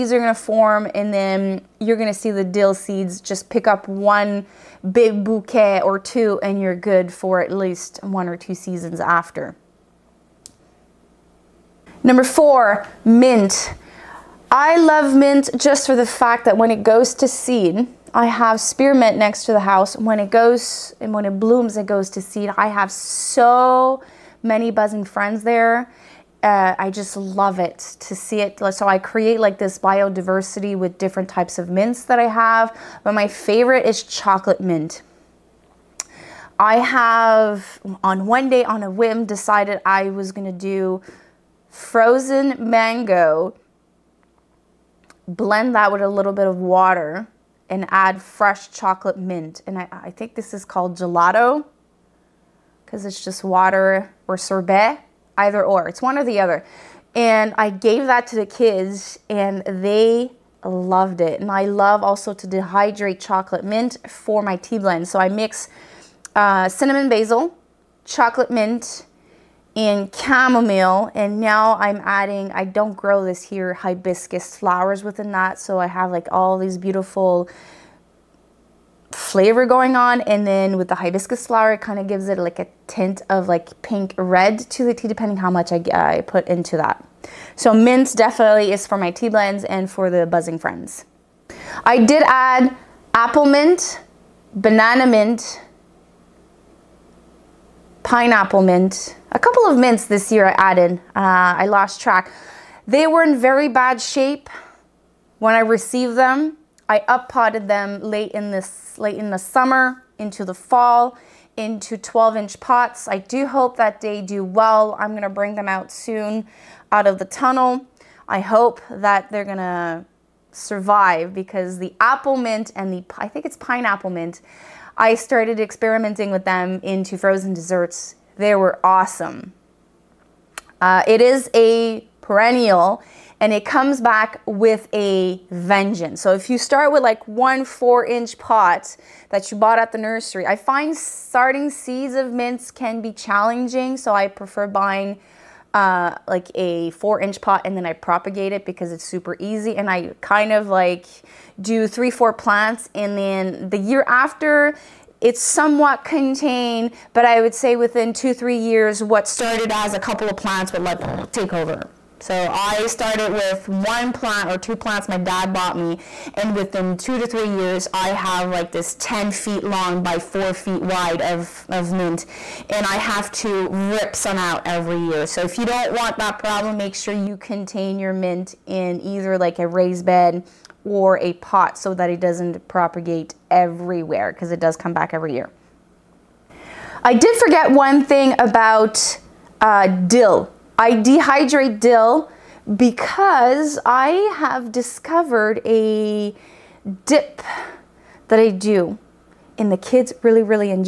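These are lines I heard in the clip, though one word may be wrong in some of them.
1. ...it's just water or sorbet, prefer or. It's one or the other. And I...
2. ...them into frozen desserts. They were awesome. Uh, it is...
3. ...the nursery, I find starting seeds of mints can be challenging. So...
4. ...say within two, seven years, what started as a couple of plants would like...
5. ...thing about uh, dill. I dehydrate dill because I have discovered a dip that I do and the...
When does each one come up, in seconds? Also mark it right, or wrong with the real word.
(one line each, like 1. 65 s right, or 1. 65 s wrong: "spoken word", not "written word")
1. 53 s wrong: "either", not "prefer"
2. 126 s right
3. 139 s right
4. 157 s wrong: "three", not "seven"
5. 188 s right.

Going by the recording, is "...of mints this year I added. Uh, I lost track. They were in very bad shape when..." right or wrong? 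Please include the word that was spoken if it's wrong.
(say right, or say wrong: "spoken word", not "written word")
right.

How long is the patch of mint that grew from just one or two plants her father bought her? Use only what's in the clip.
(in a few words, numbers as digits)
10 feet.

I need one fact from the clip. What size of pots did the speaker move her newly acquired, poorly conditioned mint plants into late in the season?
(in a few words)
12 inch.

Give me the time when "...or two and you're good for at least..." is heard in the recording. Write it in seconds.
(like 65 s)
5 s.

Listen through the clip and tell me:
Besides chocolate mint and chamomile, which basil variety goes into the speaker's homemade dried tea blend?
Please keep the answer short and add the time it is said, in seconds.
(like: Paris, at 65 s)
cinnamon basil, at 66 s.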